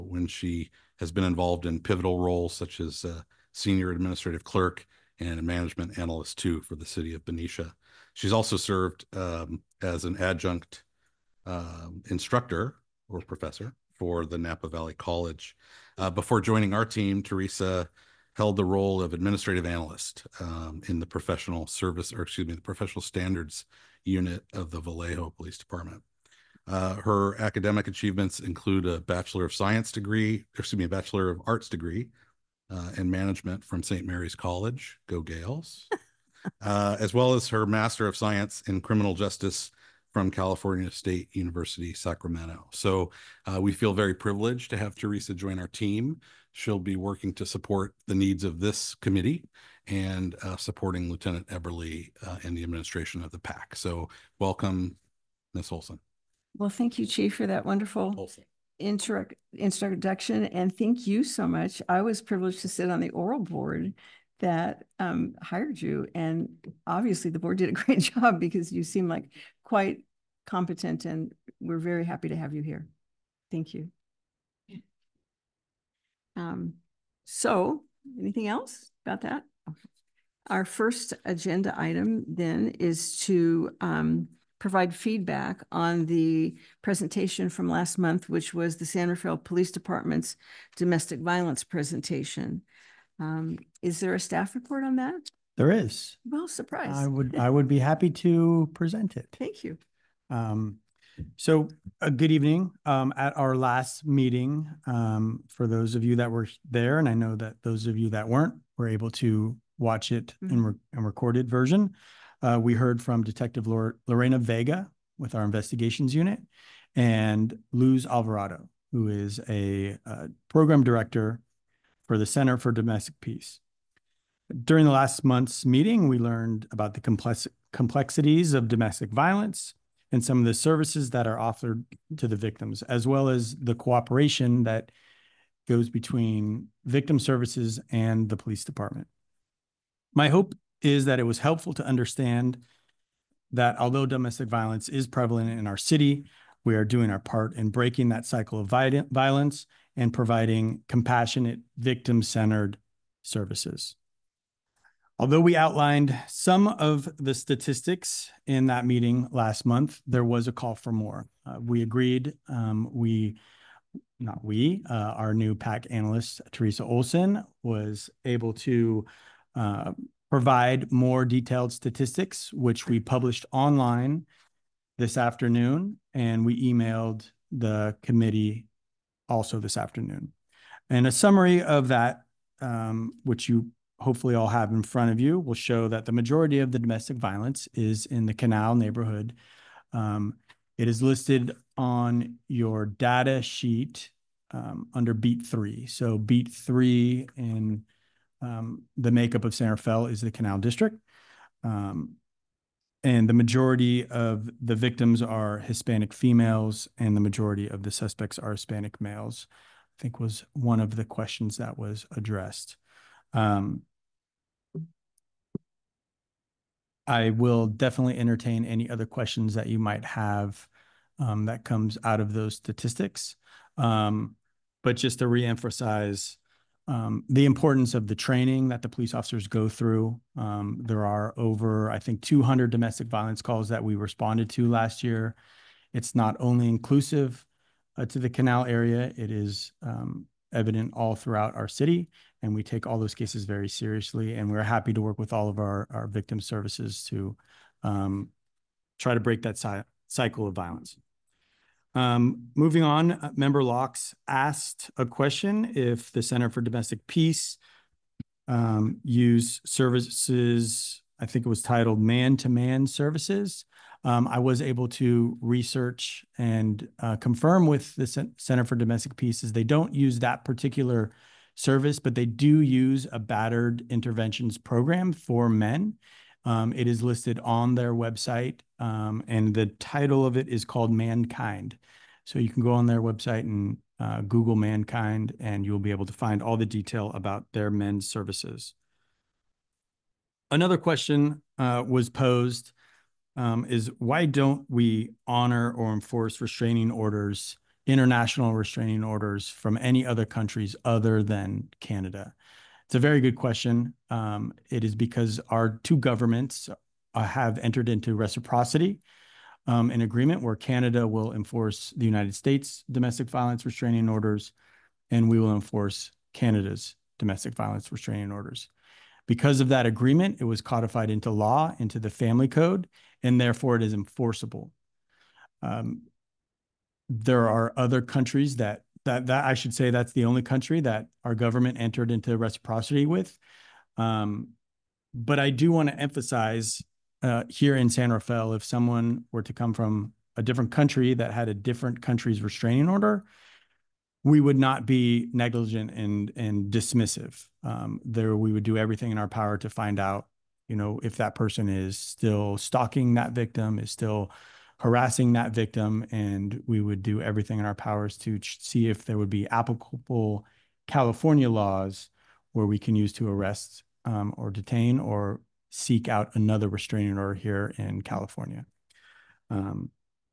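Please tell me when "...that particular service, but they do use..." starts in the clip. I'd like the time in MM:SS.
04:30.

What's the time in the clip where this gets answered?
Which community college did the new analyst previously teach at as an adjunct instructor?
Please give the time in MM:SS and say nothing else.
00:14.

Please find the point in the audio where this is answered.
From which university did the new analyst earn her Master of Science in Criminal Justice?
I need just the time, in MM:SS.
00:40.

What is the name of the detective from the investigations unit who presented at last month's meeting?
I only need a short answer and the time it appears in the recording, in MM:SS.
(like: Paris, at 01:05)
Lorena Vega, at 01:53.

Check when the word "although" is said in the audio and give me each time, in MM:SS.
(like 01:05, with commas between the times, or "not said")
02:23, 02:35.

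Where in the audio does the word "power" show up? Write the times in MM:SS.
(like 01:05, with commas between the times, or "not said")
05:49, 05:57.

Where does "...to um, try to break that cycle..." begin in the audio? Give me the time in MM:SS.
04:07.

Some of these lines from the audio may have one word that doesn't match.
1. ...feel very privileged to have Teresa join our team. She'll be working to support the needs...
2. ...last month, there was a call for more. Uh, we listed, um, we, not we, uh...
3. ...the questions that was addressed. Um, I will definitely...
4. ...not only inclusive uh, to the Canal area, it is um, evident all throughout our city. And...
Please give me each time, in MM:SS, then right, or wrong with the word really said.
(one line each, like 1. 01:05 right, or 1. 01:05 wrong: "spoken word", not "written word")
1. 00:43 right
2. 02:39 wrong: "agreed", not "listed"
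3. 03:30 right
4. 03:56 right.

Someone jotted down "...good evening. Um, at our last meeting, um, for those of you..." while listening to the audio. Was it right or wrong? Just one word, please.
right.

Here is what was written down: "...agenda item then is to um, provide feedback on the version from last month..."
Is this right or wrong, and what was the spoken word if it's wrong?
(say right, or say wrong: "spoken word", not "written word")
wrong: "presentation", not "version".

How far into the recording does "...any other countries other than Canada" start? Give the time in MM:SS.
04:59.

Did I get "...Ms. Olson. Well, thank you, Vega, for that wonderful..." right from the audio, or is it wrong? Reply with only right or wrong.
wrong.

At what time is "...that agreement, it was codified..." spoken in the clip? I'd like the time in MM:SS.
05:19.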